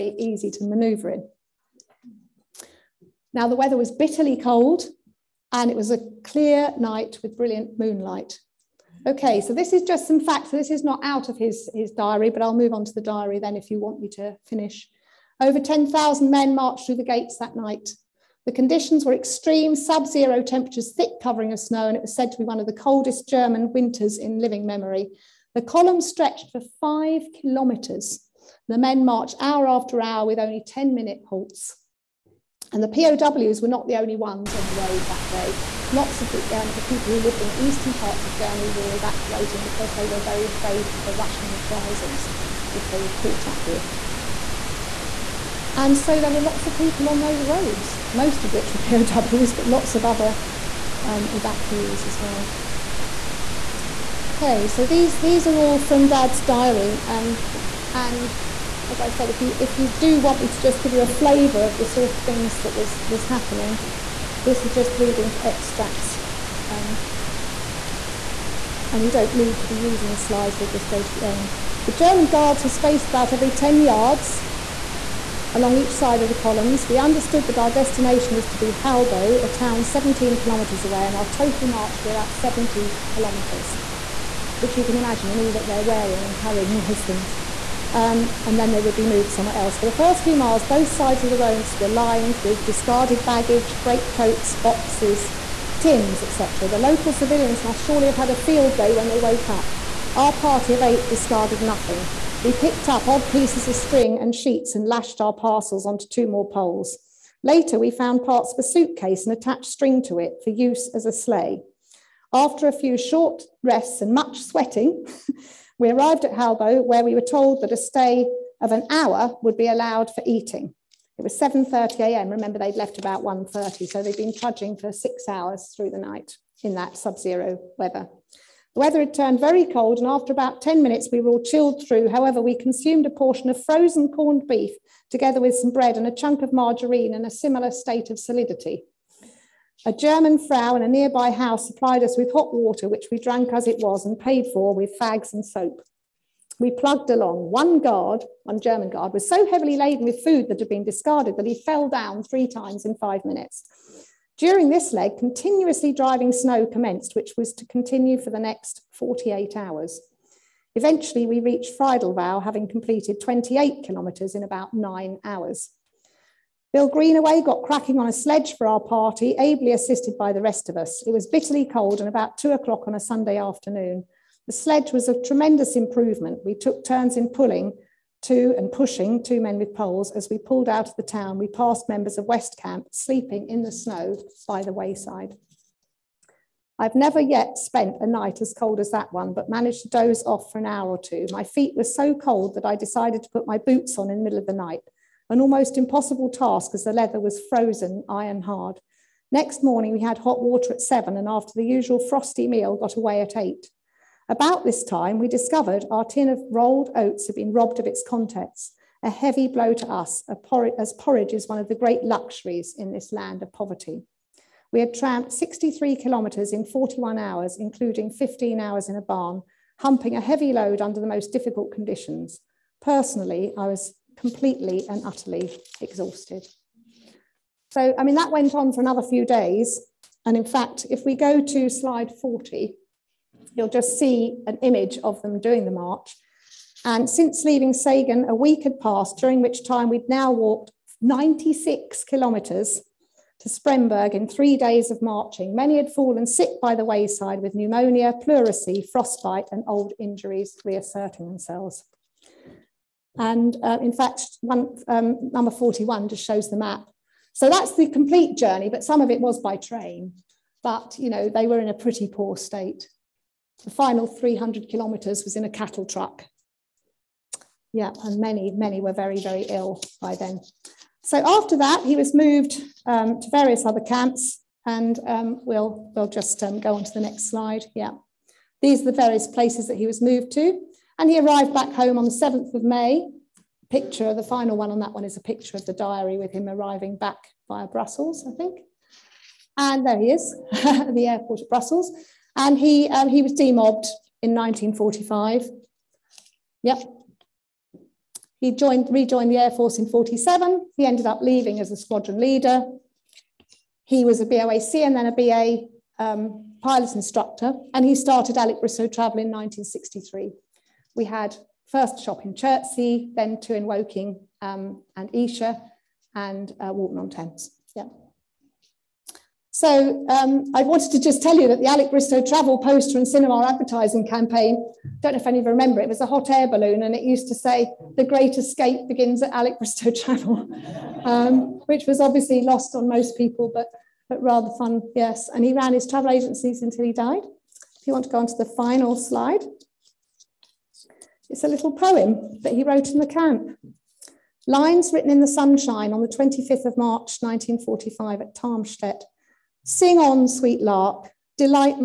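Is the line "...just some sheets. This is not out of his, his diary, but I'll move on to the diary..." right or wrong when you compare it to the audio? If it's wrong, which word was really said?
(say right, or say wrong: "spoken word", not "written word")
wrong: "facts", not "sheets".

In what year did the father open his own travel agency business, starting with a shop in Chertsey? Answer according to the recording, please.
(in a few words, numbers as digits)
1963.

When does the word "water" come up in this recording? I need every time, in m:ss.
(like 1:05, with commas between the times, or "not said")
2:22, 3:20.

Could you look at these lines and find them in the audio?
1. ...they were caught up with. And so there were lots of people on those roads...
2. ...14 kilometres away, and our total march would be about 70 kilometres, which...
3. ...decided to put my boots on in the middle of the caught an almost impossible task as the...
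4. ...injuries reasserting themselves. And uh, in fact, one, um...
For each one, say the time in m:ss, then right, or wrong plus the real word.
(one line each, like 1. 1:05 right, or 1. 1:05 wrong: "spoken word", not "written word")
1. 0:42 right
2. 1:19 wrong: "17", not "14"
3. 3:12 wrong: "night", not "caught"
4. 4:09 right.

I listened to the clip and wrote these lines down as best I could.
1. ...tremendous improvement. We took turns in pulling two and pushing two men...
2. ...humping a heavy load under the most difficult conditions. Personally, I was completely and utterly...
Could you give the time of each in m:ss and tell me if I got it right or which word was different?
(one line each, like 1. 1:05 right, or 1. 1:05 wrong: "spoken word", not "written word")
1. 2:55 right
2. 3:39 right.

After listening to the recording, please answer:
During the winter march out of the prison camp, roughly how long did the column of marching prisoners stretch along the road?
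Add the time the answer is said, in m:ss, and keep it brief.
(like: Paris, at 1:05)
5 kilometres, at 0:26.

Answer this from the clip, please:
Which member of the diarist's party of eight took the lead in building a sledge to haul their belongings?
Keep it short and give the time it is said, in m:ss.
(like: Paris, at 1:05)
Bill Greenaway, at 2:46.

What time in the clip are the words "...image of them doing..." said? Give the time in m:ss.
3:54.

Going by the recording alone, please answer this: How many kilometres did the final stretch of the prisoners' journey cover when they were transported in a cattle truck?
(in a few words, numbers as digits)
300 kilometres.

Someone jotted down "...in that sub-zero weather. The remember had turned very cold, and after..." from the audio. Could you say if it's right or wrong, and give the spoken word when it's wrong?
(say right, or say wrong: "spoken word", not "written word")
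wrong: "weather", not "remember".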